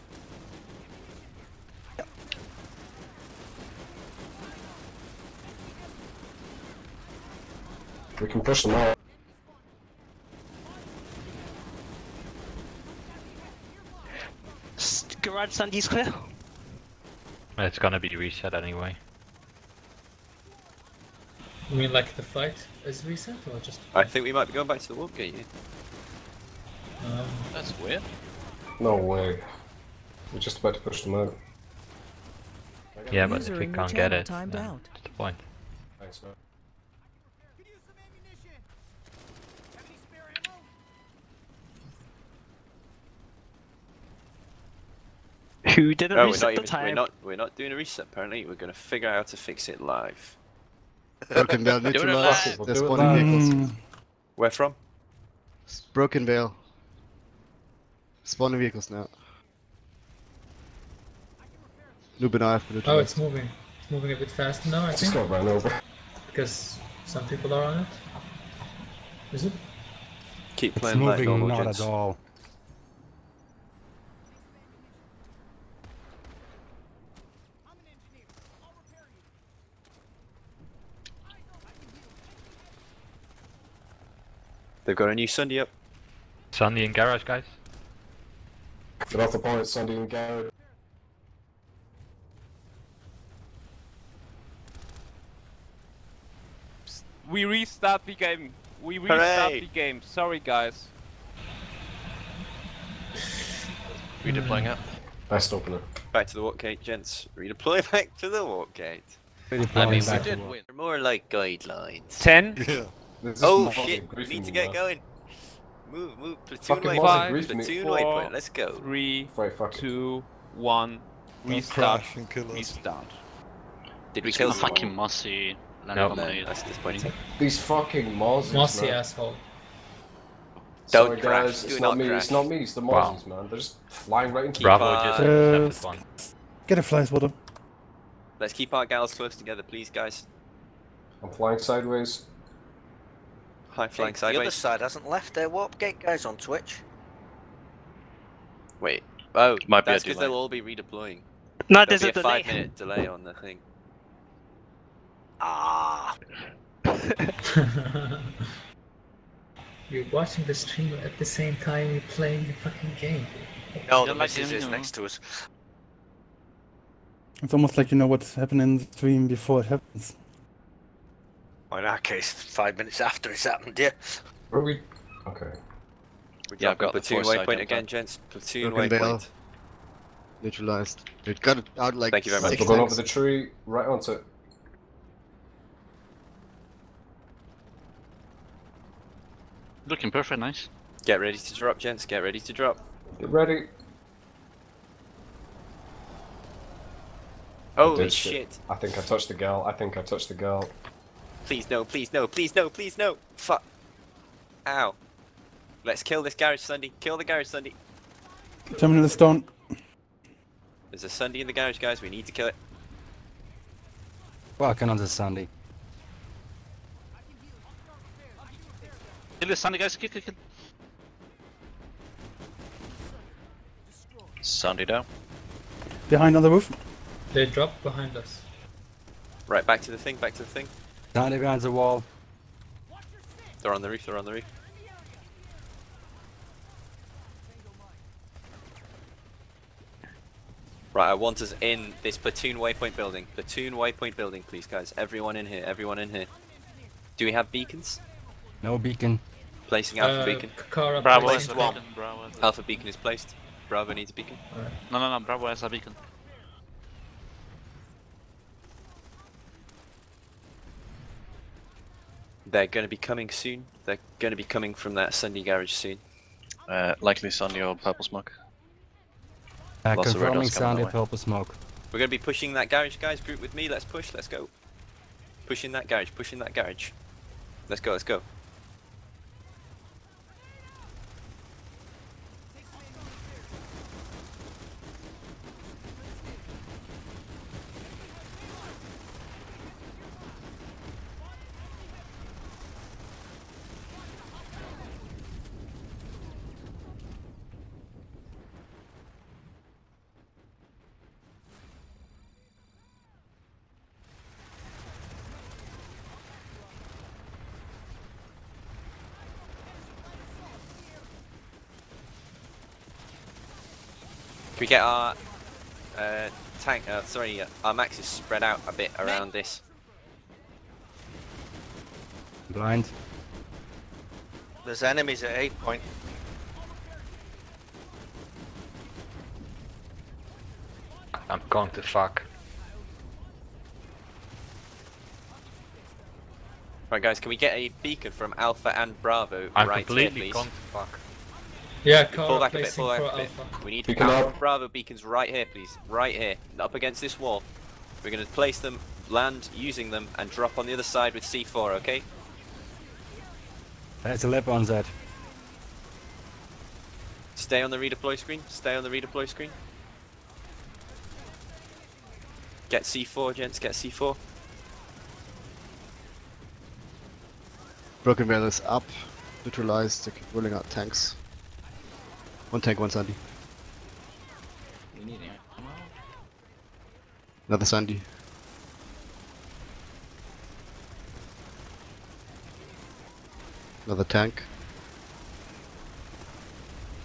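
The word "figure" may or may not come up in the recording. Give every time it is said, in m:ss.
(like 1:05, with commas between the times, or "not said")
0:48.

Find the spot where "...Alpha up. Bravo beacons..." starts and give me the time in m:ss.
5:44.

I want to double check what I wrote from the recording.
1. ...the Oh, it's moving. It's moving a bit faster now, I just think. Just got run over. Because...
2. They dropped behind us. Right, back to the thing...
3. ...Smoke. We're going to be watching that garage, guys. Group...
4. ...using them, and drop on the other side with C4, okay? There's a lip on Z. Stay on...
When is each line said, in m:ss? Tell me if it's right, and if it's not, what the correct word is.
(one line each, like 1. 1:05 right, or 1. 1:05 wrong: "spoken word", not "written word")
1. 1:02 right
2. 3:47 right
3. 4:31 wrong: "pushing", not "watching"
4. 5:49 right.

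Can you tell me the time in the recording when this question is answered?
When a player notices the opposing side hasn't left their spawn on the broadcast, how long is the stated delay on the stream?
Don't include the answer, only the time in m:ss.
2:32.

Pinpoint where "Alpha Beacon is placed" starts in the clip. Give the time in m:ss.
4:12.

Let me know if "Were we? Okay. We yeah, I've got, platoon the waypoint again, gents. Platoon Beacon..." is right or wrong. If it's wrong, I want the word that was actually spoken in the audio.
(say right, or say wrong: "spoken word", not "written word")
wrong: "Broken", not "Beacon".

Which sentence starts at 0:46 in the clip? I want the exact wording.
We're not, we're not doing a reset, apparently.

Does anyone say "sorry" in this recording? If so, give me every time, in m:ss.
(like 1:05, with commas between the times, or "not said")
1:40, 1:59, 2:11, 5:17.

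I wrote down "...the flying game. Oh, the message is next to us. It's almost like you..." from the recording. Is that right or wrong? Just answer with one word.
wrong.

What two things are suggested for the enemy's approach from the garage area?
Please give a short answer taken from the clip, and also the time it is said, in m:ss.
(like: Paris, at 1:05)
Sunday or Purple Smoke, at 4:27.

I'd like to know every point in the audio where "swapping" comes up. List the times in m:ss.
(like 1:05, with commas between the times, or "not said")
not said.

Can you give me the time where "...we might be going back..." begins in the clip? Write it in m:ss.
0:24.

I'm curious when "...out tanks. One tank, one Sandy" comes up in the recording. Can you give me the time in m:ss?
6:10.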